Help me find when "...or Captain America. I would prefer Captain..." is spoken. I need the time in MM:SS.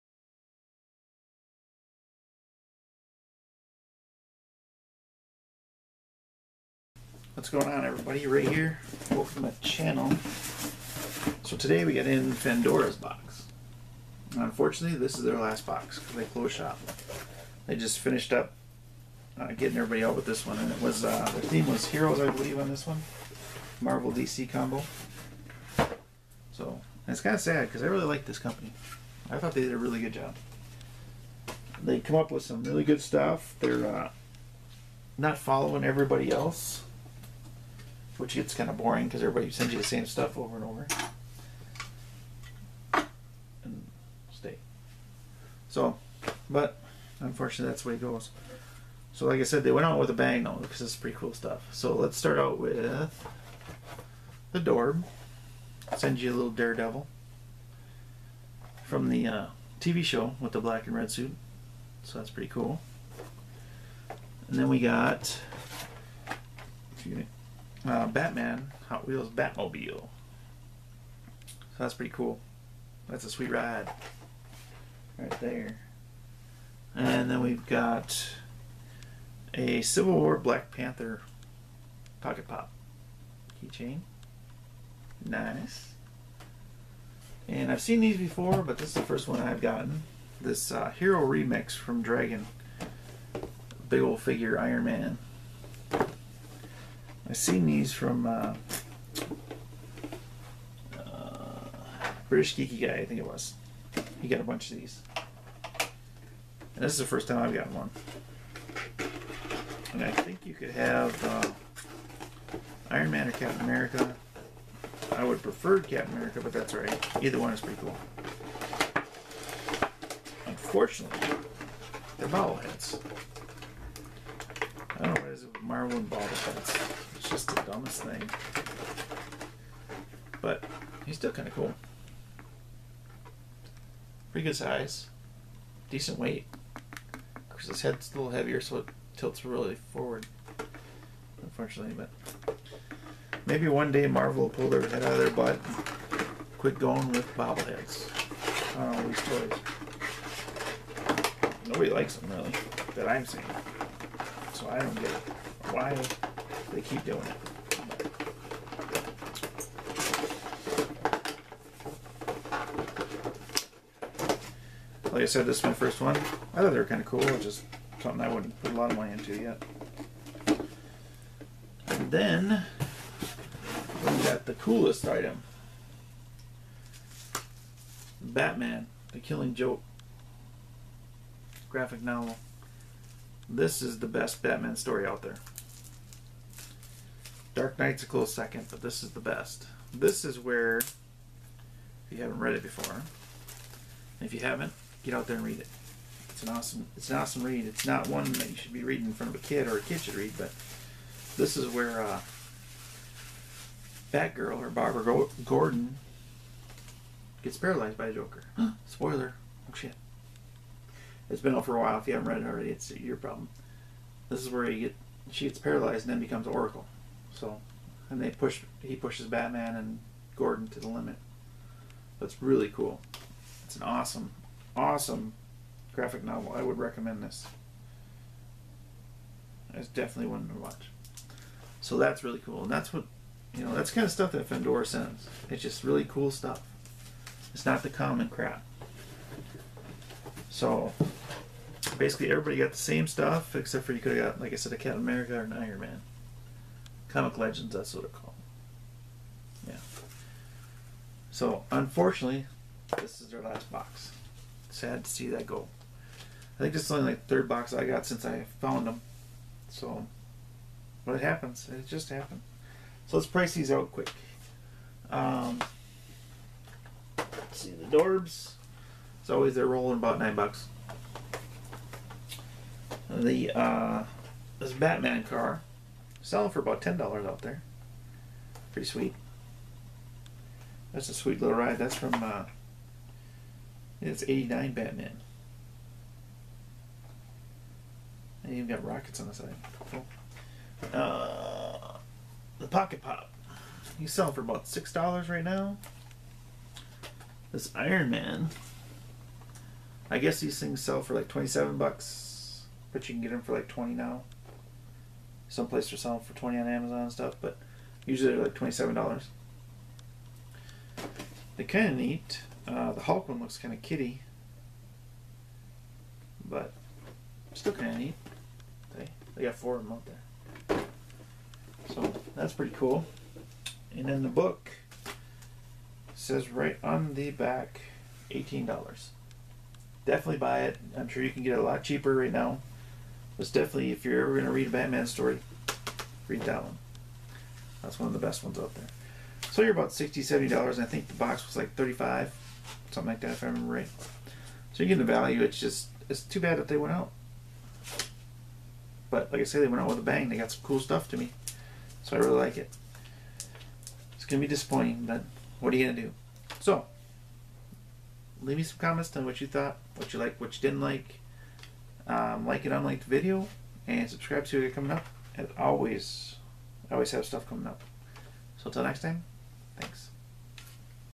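01:53.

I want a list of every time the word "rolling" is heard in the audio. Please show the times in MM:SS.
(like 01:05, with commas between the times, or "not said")
04:29.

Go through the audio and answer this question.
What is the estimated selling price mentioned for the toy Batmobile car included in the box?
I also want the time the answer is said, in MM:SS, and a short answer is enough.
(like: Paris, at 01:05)
$10, at 04:36.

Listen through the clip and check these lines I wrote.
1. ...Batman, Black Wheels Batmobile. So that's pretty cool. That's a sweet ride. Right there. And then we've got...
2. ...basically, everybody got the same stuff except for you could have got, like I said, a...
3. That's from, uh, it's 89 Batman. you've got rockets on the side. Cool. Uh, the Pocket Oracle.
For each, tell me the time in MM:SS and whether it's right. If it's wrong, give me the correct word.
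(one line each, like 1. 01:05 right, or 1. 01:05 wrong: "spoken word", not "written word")
1. 01:08 wrong: "Hot", not "Black"
2. 04:01 right
3. 04:41 wrong: "Pop", not "Oracle".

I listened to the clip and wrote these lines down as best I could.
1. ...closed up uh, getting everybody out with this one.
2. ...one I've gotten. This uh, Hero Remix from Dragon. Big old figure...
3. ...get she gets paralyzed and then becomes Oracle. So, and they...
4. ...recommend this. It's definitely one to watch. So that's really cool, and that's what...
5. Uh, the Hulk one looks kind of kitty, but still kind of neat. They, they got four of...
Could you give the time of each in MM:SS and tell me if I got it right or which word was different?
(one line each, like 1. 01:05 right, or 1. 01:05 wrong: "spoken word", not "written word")
1. 00:17 wrong: "finished", not "closed"
2. 01:29 right
3. 03:34 right
4. 03:46 right
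5. 05:12 right.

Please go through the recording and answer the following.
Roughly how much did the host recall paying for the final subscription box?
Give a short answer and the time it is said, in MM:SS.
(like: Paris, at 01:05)
35, at 05:41.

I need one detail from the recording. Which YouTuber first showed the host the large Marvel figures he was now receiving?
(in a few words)
British Geeky Guy.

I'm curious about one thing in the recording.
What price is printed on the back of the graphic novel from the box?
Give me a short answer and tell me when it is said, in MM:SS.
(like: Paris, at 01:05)
$18, at 05:28.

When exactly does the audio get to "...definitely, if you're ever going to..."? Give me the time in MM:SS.
05:33.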